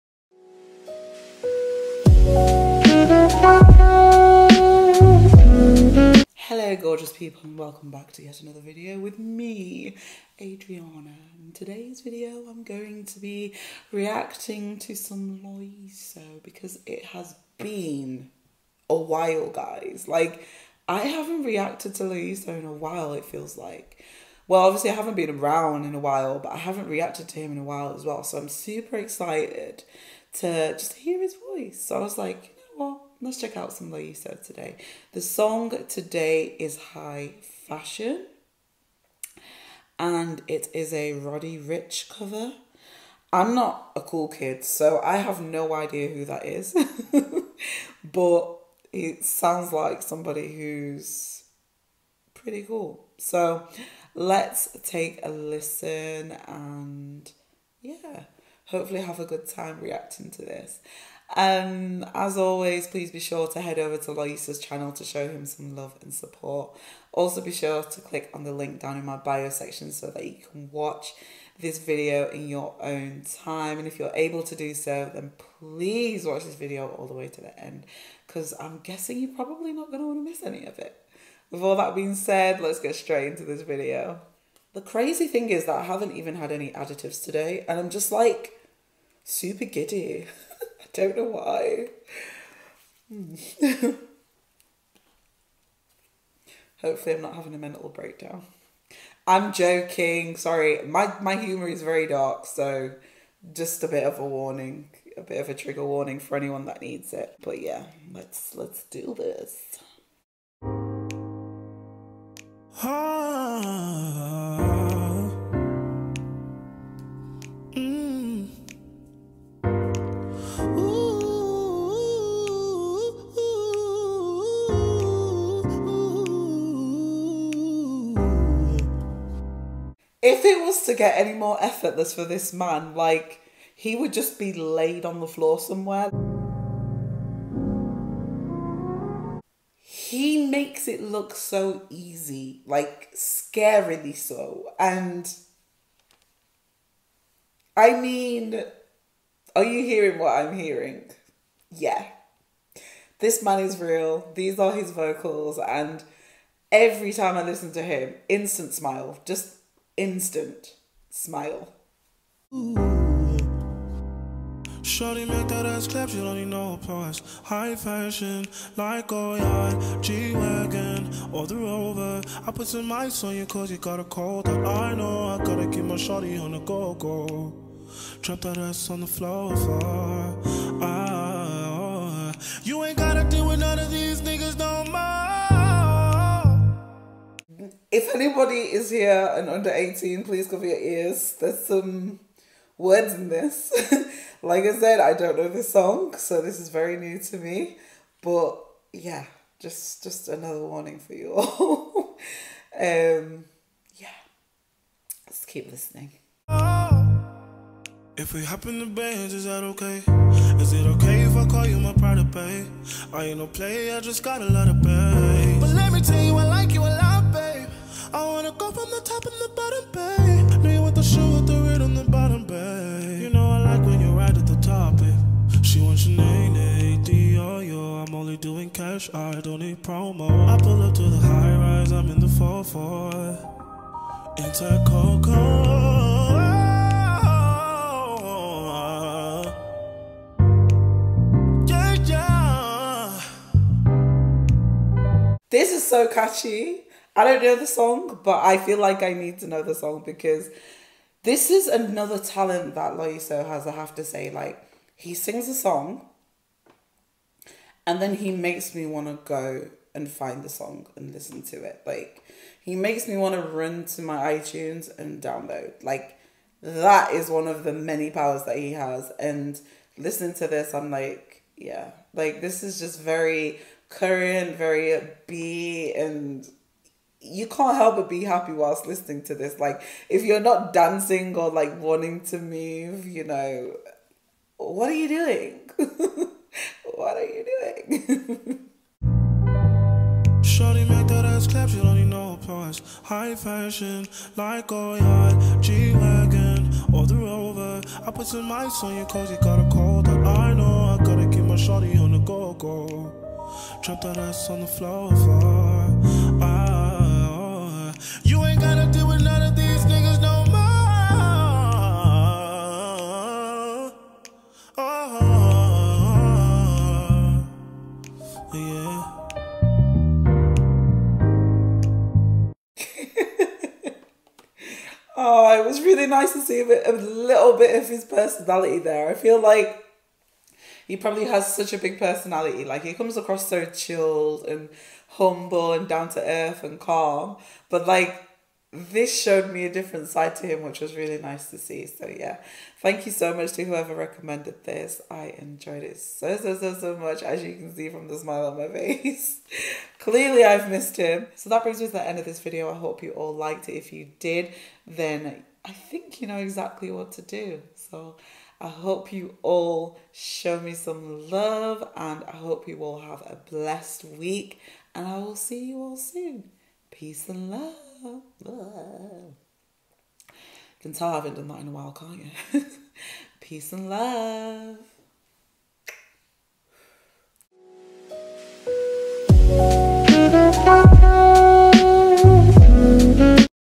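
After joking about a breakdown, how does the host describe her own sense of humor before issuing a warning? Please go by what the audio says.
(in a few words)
very dark.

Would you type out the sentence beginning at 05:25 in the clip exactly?
Oh, it was really nice to see a, bit, a little bit of his personality there.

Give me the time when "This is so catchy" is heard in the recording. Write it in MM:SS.
04:05.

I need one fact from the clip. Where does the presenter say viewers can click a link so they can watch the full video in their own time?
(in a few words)
bio section.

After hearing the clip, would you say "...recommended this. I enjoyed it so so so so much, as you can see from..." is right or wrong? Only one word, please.
right.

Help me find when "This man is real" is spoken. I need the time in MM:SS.
02:33.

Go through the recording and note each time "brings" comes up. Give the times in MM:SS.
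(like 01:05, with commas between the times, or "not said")
05:51.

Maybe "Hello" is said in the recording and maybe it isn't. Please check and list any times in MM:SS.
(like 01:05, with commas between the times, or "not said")
00:06.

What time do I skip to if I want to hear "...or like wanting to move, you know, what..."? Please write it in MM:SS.
04:41.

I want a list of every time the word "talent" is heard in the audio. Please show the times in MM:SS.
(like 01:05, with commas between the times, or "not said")
04:12.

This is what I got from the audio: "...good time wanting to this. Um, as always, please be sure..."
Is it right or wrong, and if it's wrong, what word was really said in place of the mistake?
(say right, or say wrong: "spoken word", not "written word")
wrong: "reacting", not "wanting".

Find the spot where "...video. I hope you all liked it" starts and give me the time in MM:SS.
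05:52.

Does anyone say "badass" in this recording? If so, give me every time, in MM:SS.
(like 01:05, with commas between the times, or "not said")
not said.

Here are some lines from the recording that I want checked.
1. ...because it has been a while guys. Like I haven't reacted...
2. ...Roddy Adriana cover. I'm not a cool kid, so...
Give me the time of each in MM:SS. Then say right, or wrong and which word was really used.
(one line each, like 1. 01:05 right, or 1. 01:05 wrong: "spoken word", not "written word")
1. 00:16 right
2. 00:41 wrong: "Ricch", not "Adriana".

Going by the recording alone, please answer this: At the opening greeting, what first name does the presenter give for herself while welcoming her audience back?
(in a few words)
Adriana.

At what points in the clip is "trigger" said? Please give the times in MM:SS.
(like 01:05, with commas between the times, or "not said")
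01:45.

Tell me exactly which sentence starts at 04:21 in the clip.
Like, he makes me want to run to my iTunes and download.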